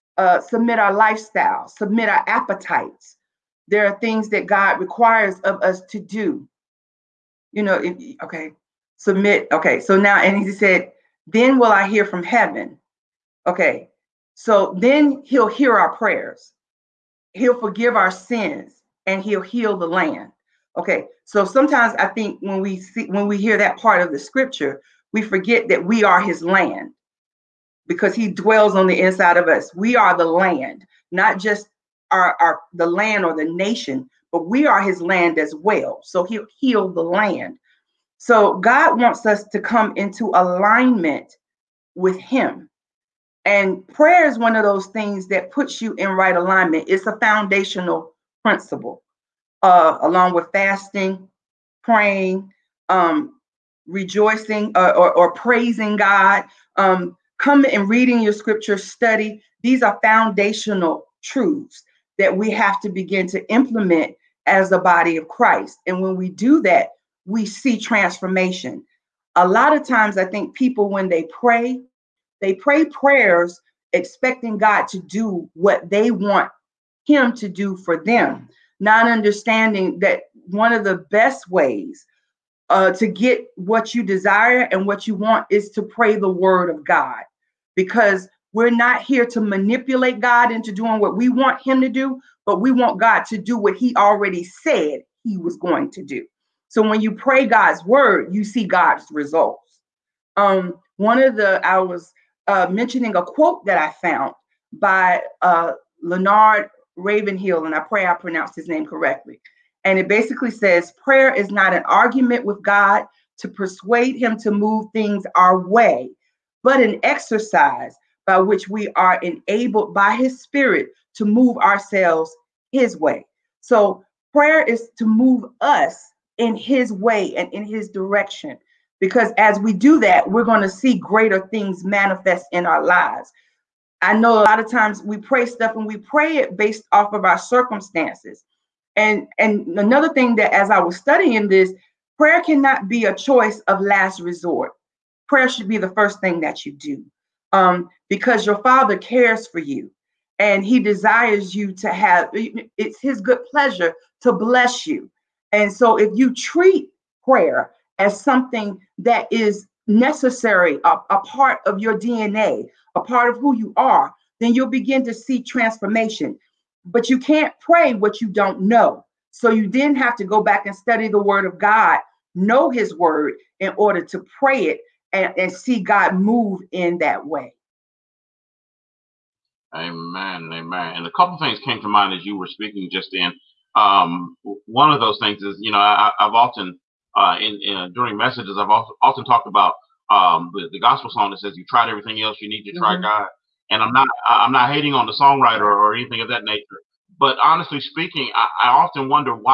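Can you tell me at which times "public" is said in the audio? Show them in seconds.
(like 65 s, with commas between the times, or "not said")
not said.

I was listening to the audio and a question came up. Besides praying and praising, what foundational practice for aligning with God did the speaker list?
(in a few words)
Fasting.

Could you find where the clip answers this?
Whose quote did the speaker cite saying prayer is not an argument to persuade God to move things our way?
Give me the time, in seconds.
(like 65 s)
106 s.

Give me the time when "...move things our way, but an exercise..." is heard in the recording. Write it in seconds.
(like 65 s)
114 s.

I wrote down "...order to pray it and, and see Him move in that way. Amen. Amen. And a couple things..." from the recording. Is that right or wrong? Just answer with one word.
wrong.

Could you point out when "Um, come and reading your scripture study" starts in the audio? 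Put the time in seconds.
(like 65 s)
56 s.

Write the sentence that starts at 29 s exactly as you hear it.
We are the land, not just our, our the land or the nation, but we are his land as well.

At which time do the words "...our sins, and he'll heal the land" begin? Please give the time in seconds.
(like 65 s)
17 s.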